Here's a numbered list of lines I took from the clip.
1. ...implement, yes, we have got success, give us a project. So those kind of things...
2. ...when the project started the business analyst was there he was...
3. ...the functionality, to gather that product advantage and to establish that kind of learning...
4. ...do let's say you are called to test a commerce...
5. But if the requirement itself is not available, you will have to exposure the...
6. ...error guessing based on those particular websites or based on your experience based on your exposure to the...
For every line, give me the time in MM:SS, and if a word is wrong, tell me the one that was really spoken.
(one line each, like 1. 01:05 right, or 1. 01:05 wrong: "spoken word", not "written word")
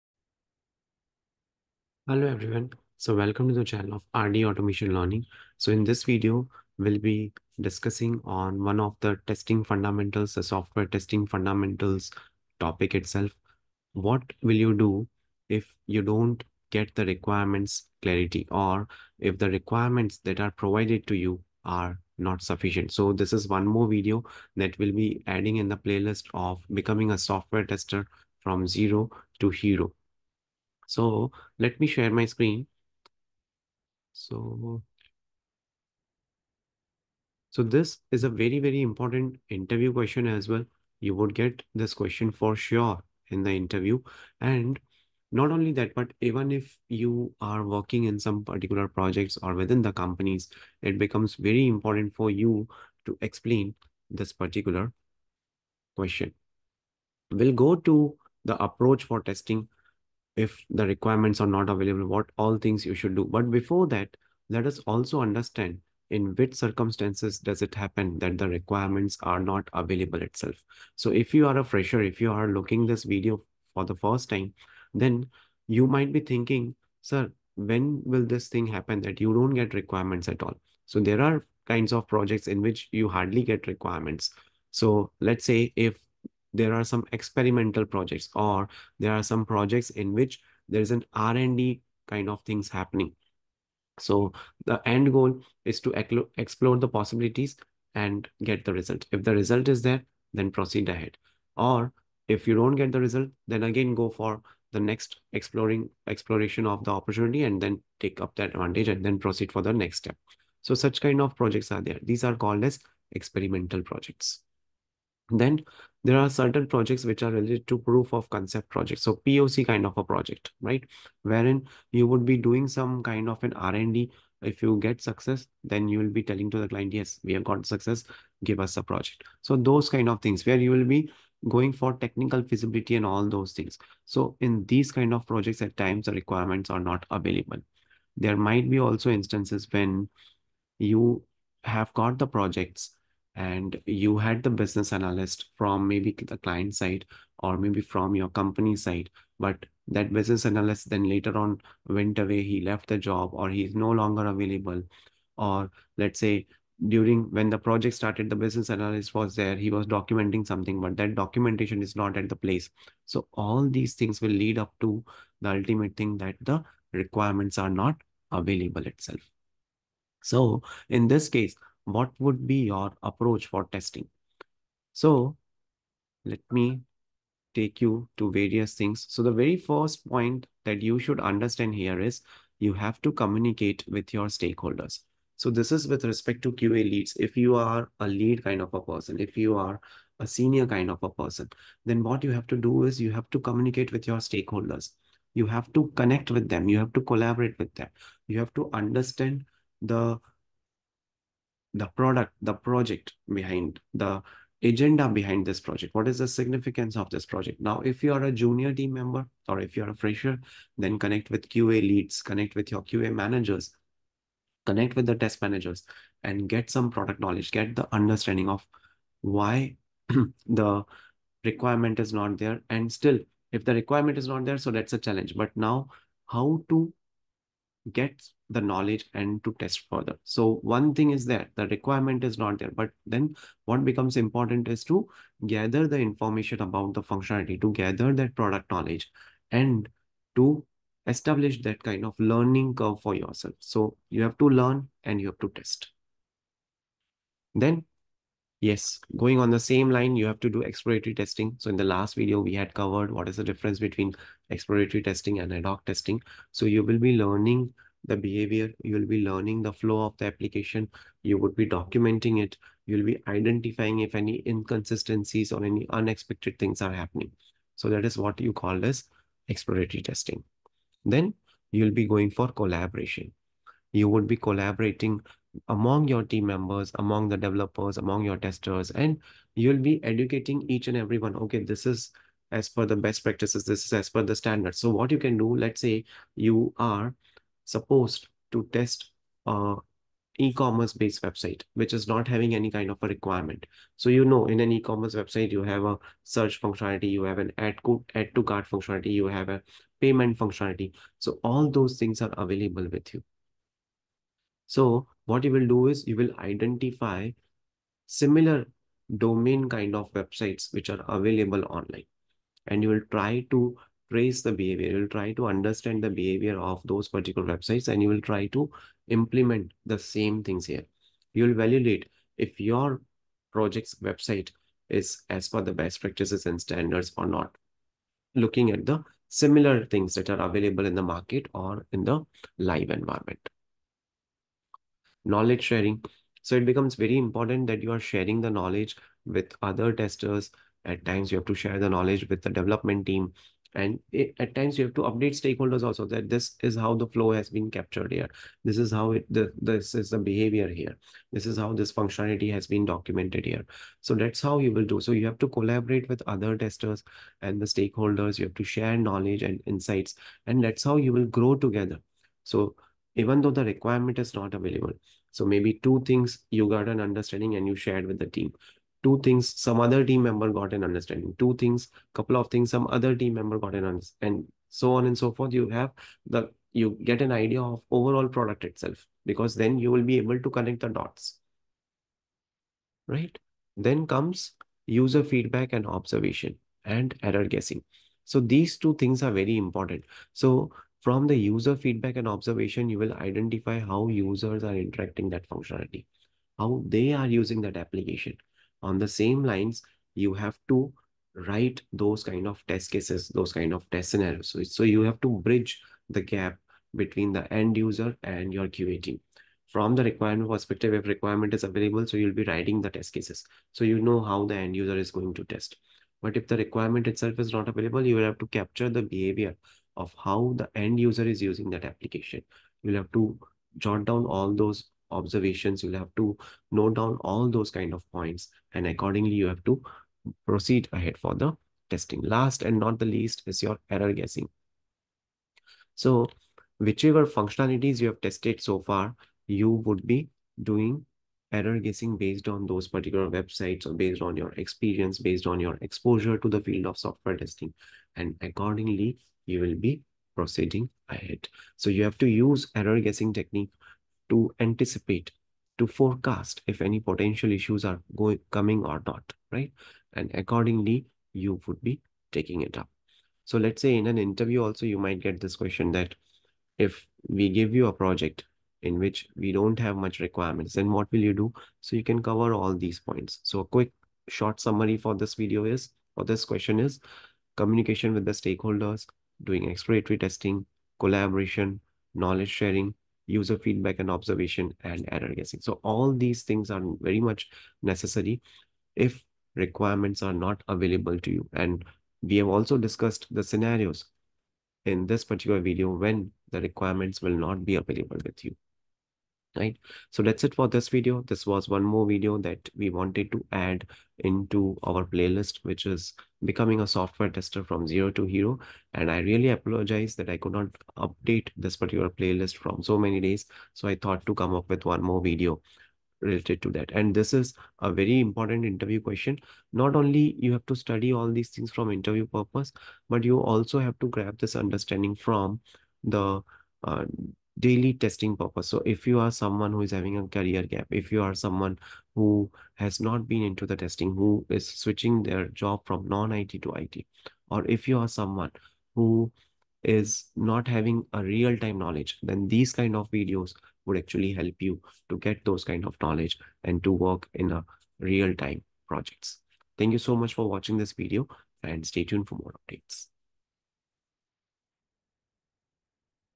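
1. 02:06 wrong: "client", not "implement"
2. 02:37 right
3. 03:56 wrong: "knowledge", not "advantage"
4. 04:45 wrong: "supposed", not "called"
5. 06:56 wrong: "capture", not "exposure"
6. 07:21 right.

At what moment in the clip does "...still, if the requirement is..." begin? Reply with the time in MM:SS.
03:42.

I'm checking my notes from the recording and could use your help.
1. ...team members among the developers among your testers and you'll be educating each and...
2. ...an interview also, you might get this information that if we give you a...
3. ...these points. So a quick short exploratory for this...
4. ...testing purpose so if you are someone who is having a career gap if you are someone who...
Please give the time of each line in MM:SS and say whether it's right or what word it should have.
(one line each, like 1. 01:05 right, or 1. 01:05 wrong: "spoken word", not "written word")
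1. 04:36 right
2. 07:44 wrong: "question", not "information"
3. 07:52 wrong: "summary", not "exploratory"
4. 08:47 right.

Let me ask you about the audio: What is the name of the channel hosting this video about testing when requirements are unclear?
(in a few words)
RD Automation Learning.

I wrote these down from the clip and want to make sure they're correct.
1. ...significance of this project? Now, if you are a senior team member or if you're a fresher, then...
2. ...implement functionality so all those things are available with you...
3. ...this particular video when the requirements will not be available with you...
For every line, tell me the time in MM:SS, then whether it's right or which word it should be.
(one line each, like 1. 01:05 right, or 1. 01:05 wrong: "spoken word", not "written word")
1. 03:26 wrong: "junior", not "senior"
2. 04:59 wrong: "payment", not "implement"
3. 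08:15 right.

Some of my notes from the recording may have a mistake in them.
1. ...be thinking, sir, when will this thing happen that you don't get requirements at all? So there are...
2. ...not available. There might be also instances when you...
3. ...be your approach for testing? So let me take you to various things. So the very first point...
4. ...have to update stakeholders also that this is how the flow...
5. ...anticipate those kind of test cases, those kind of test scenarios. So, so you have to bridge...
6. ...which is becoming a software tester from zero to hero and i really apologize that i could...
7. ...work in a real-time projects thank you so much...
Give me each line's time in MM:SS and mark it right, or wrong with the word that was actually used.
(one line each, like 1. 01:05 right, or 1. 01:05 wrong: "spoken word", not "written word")
1. 01:16 right
2. 02:16 right
3. 02:52 right
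4. 05:44 right
5. 06:41 wrong: "write", not "anticipate"
6. 08:25 right
7. 09:06 right.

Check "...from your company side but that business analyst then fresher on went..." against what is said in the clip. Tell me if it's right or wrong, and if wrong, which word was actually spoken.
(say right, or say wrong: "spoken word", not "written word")
wrong: "later", not "fresher".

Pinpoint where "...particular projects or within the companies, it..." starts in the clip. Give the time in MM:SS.
00:48.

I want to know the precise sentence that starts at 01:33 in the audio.
So the end goal is to explore the possibilities and get the result.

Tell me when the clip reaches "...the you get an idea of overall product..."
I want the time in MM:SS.
06:16.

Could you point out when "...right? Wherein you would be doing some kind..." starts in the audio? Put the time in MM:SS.
02:00.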